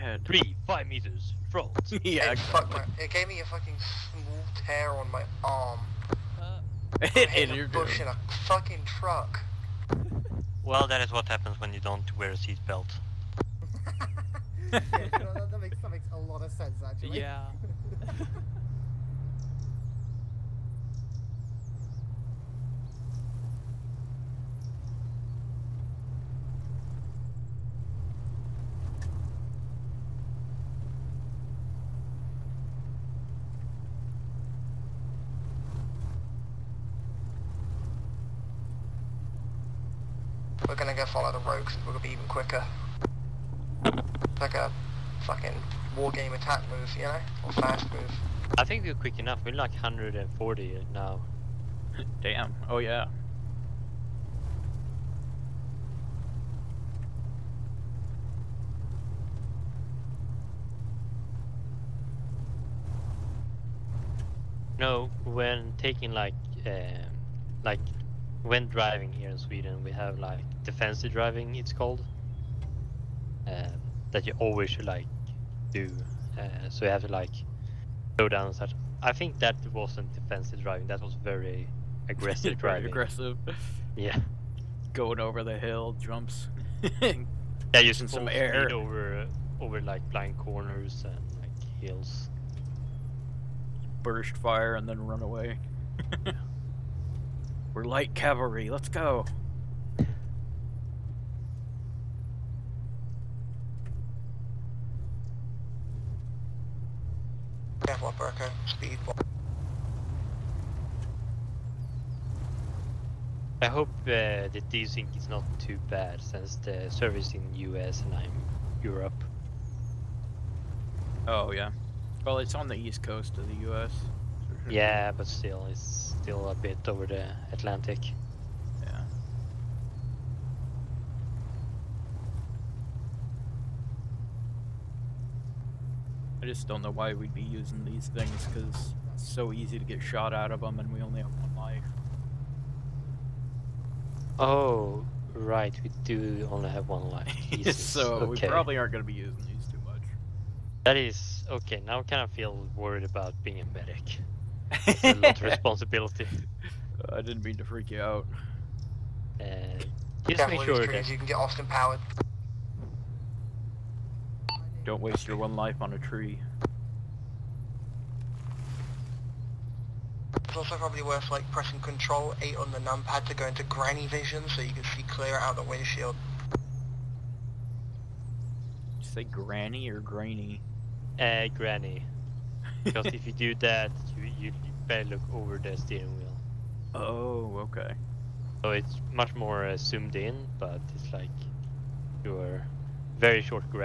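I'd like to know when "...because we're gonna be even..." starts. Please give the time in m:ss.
0:41.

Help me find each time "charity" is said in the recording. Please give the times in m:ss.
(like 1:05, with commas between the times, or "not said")
not said.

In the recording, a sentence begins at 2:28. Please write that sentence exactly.
we probably aren't going to be using these too much.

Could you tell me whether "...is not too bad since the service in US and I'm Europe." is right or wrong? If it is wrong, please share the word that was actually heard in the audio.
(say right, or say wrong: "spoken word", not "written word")
right.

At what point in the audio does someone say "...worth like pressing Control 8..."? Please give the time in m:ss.
2:51.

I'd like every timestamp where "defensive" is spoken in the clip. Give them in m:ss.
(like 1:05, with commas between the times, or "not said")
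1:10, 1:20.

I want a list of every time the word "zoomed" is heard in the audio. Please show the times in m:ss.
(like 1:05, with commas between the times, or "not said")
3:09.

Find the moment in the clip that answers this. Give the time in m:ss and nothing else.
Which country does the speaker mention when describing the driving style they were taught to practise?
1:09.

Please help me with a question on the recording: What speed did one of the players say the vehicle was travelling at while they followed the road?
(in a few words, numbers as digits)
140.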